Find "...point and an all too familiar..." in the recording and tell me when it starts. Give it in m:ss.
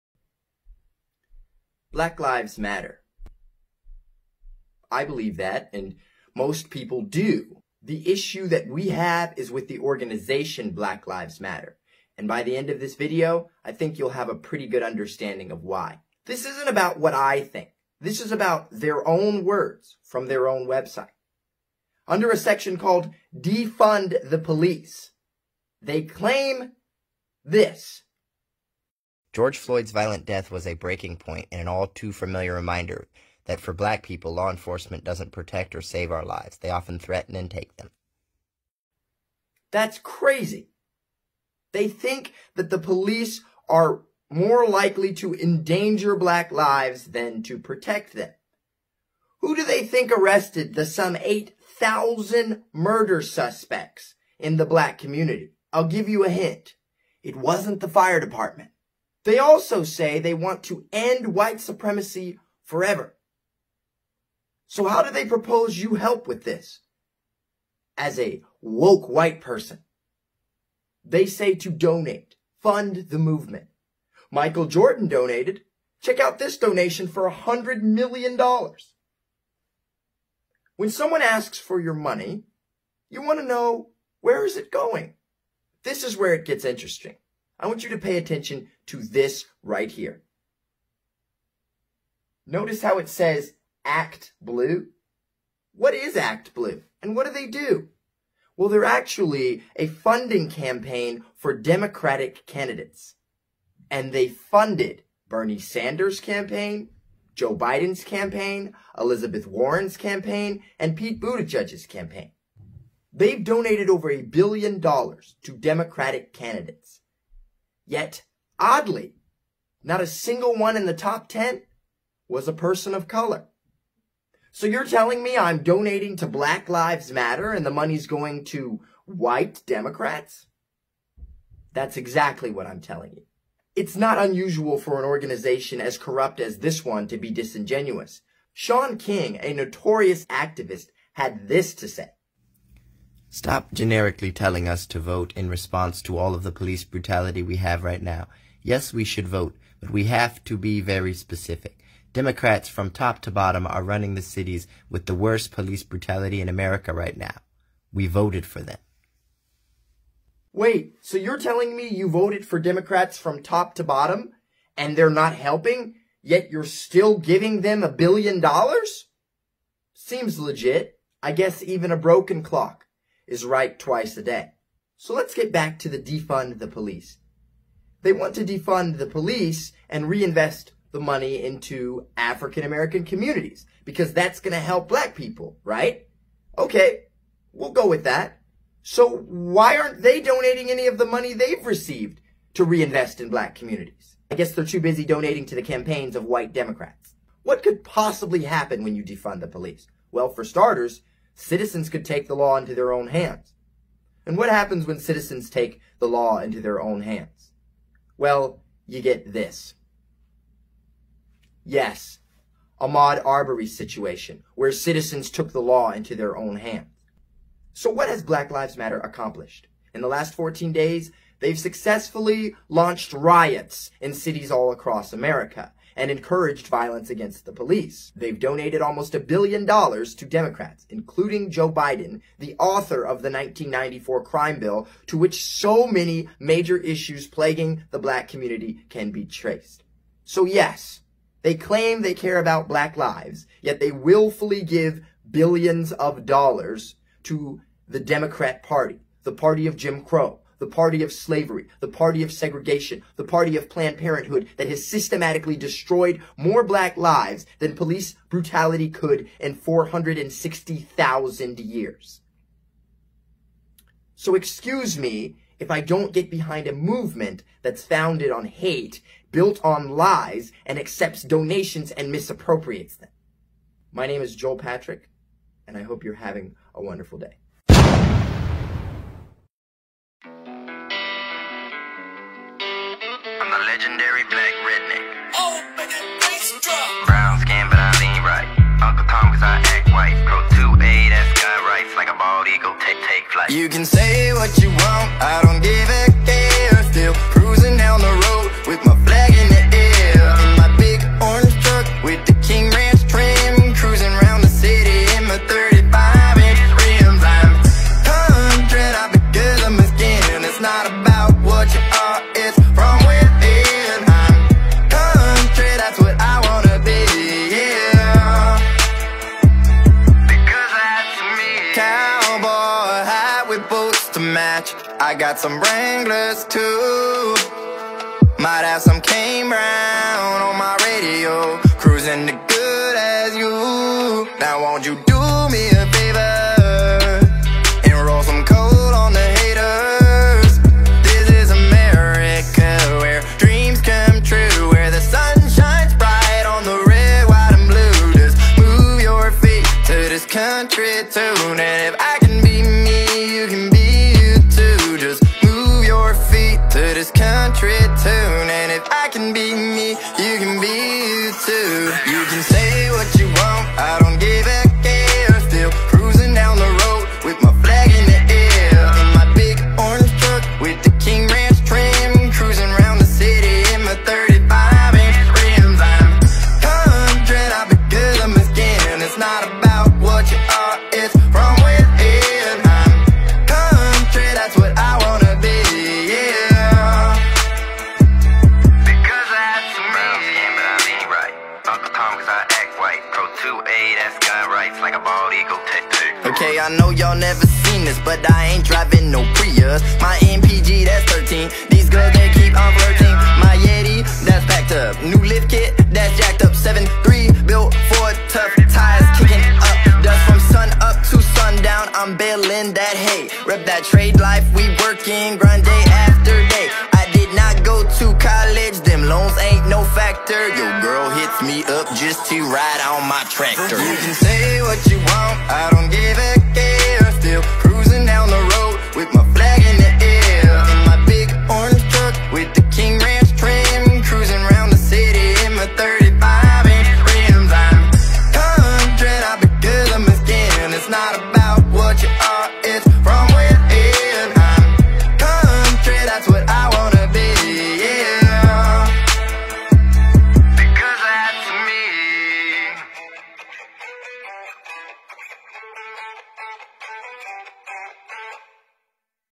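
0:31.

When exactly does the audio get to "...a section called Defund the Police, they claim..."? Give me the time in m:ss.
0:22.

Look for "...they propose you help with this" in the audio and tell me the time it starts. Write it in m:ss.
1:05.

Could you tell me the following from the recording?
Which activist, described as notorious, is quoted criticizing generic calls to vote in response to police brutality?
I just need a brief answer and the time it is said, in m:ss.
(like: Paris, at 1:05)
Shaun King, at 2:18.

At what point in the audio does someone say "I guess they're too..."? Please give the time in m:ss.
3:14.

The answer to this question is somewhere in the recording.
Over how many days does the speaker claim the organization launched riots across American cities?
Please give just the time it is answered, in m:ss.
3:40.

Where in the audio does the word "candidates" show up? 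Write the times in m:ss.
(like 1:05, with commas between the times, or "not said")
1:42, 1:56.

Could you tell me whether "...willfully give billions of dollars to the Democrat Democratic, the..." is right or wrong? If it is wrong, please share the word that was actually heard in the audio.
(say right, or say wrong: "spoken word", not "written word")
wrong: "Party", not "Democratic".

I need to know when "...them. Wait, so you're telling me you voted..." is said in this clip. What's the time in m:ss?
2:38.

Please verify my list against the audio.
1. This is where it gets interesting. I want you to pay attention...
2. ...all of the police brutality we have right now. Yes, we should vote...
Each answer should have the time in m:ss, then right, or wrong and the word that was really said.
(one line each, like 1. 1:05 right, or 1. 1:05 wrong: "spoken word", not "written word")
1. 1:25 right
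2. 2:26 right.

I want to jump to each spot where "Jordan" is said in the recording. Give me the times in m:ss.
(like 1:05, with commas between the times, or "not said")
1:14.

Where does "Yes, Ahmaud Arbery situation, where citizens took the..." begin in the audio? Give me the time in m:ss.
3:31.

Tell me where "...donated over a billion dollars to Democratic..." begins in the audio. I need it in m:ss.
1:53.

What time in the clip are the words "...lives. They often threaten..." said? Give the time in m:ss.
0:36.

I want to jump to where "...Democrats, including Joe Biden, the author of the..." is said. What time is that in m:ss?
3:50.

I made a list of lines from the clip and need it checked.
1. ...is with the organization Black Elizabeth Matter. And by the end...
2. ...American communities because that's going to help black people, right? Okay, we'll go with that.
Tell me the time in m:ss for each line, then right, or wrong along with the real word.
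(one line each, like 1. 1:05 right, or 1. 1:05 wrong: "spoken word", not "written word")
1. 0:09 wrong: "Lives", not "Elizabeth"
2. 3:02 right.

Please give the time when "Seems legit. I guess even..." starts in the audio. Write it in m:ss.
2:49.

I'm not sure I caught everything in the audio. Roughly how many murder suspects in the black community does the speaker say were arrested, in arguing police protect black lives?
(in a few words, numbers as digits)
8,000.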